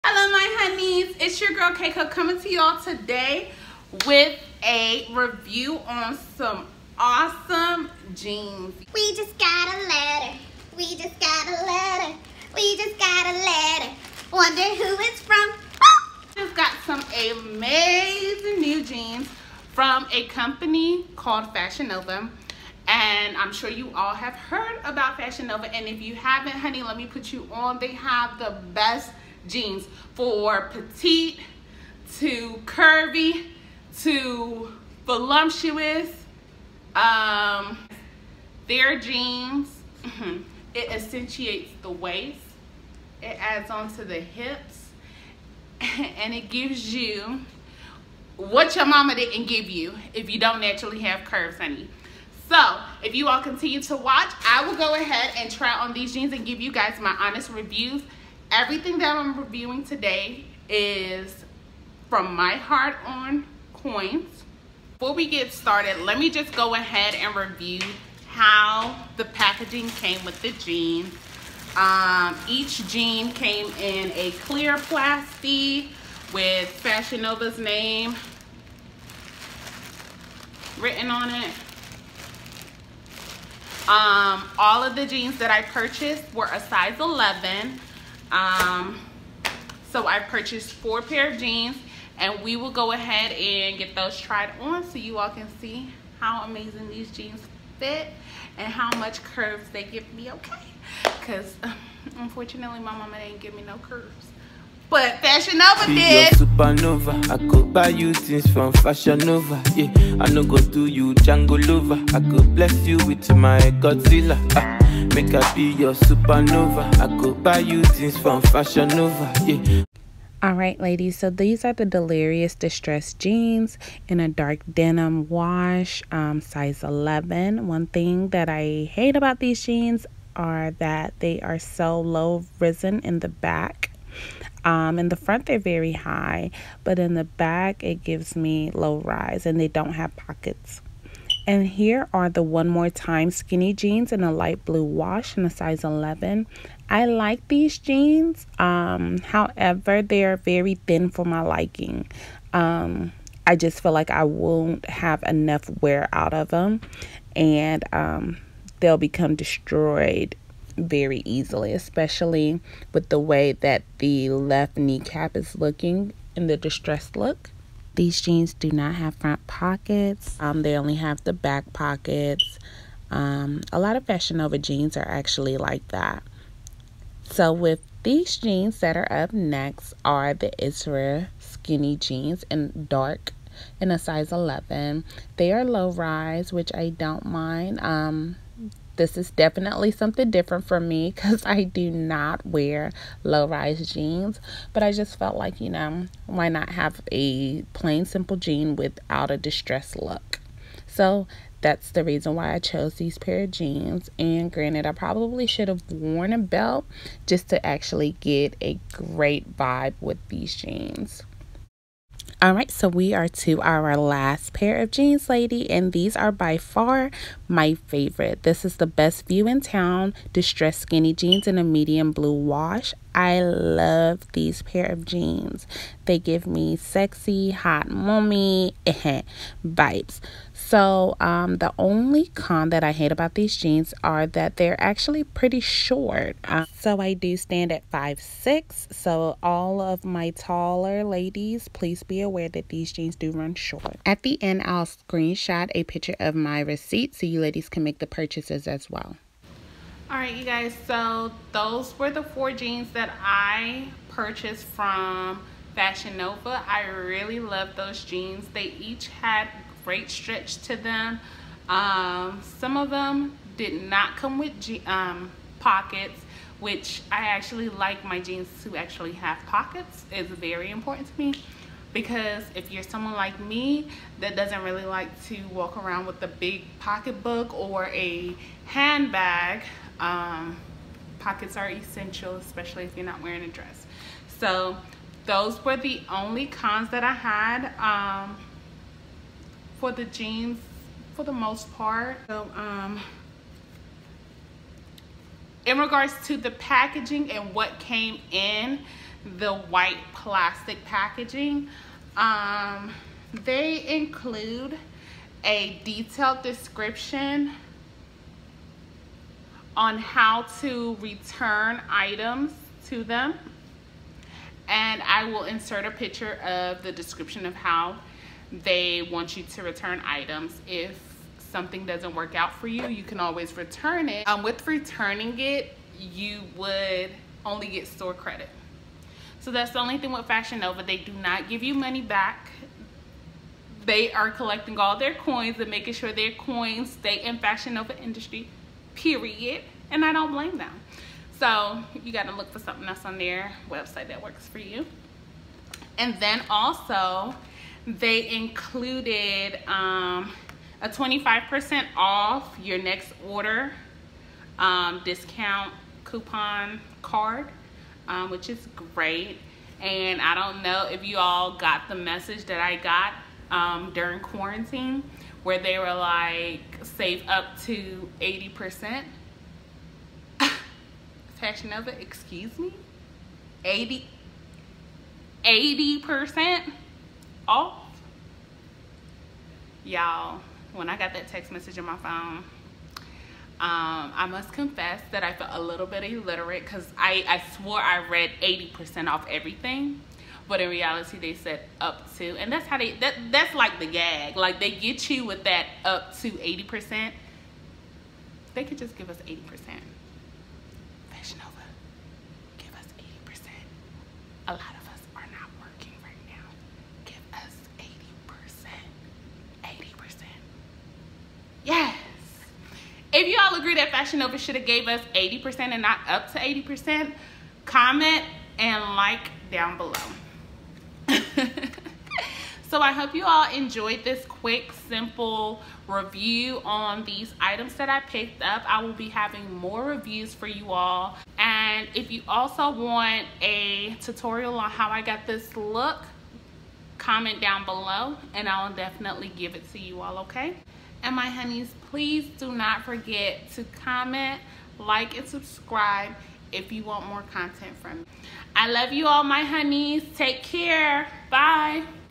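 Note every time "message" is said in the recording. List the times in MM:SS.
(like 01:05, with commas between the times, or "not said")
06:01, 06:21.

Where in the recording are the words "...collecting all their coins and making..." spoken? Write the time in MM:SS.
05:34.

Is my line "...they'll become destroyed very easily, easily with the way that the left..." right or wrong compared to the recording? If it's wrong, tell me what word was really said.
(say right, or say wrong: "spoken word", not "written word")
wrong: "especially", not "easily".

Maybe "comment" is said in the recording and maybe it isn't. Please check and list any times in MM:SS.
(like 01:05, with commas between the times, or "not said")
06:57, 07:16, 07:23.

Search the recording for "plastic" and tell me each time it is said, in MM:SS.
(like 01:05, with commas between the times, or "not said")
01:14, 05:00.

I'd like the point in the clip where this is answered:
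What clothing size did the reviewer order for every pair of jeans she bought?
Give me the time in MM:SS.
01:26.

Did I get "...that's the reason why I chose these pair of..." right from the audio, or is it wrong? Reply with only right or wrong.
right.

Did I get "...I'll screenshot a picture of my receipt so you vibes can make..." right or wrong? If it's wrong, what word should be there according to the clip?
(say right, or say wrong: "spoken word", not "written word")
wrong: "ladies", not "vibes".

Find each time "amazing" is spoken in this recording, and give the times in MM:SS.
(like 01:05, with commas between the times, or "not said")
00:17, 01:36.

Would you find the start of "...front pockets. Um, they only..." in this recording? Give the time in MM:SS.
02:49.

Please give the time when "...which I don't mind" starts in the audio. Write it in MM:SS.
03:06.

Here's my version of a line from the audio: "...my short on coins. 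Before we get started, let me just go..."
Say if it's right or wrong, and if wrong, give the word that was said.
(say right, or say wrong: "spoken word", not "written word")
wrong: "heart", not "short".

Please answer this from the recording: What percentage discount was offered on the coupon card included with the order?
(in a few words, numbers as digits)
25%.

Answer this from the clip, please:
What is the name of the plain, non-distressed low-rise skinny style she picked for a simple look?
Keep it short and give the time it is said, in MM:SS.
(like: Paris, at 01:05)
Ezra, at 03:00.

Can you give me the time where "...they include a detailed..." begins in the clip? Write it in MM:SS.
05:03.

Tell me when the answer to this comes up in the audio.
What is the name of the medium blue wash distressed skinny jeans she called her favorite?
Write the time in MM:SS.
03:38.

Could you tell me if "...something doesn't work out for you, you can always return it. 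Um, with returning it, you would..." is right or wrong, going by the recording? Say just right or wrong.
right.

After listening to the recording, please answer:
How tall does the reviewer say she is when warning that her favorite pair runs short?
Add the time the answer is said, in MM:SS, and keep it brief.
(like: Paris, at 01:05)
5'6", at 03:57.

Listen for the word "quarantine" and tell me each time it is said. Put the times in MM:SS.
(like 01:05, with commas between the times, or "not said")
06:04.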